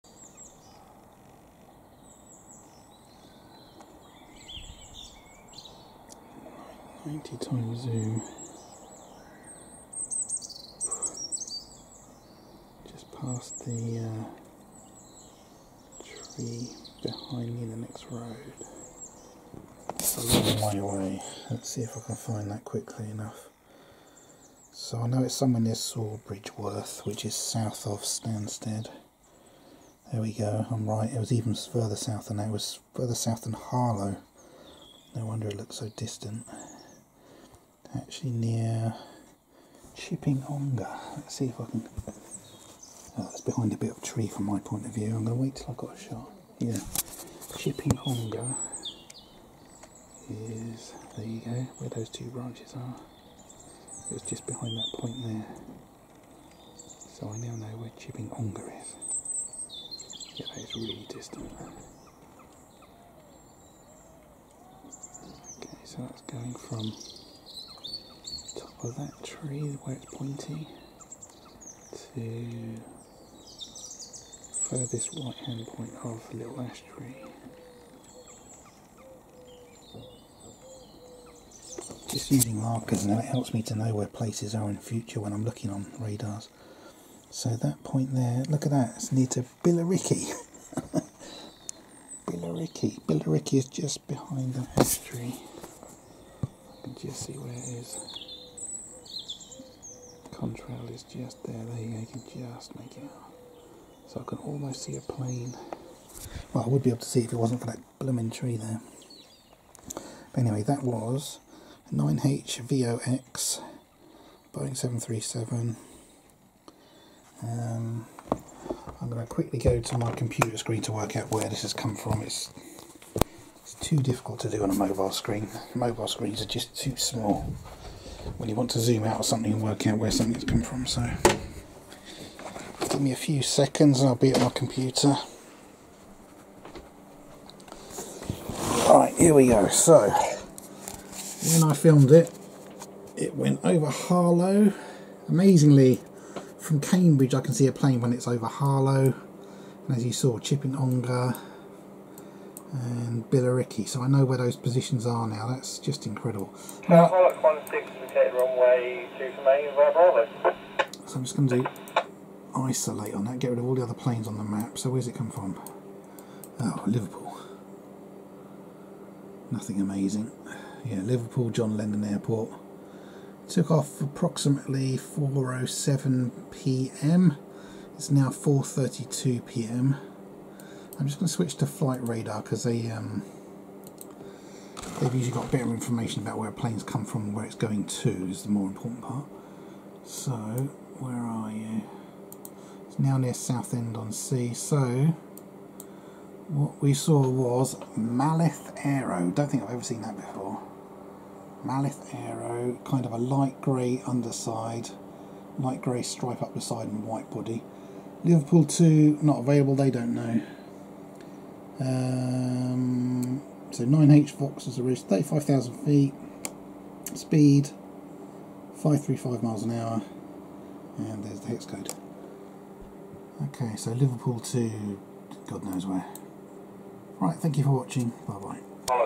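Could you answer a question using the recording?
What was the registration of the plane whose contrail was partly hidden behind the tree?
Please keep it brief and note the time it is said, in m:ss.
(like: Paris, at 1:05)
9H-VOX, at 1:51.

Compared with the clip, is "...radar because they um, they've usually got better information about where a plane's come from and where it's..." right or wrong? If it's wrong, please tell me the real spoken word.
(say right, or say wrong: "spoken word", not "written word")
right.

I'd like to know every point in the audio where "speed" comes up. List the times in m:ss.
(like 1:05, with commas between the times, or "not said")
3:37.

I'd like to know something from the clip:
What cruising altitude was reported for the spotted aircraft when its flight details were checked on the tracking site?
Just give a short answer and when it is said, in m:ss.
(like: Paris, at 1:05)
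35,000 feet, at 3:35.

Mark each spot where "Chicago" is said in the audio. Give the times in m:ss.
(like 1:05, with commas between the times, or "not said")
not said.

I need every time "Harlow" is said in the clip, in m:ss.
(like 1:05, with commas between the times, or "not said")
0:33, 2:23, 2:28.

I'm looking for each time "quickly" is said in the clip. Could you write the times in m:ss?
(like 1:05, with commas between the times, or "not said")
0:22, 1:59.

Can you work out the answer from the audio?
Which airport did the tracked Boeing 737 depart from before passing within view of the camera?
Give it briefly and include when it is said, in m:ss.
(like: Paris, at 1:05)
Liverpool John Lennon Airport, at 2:51.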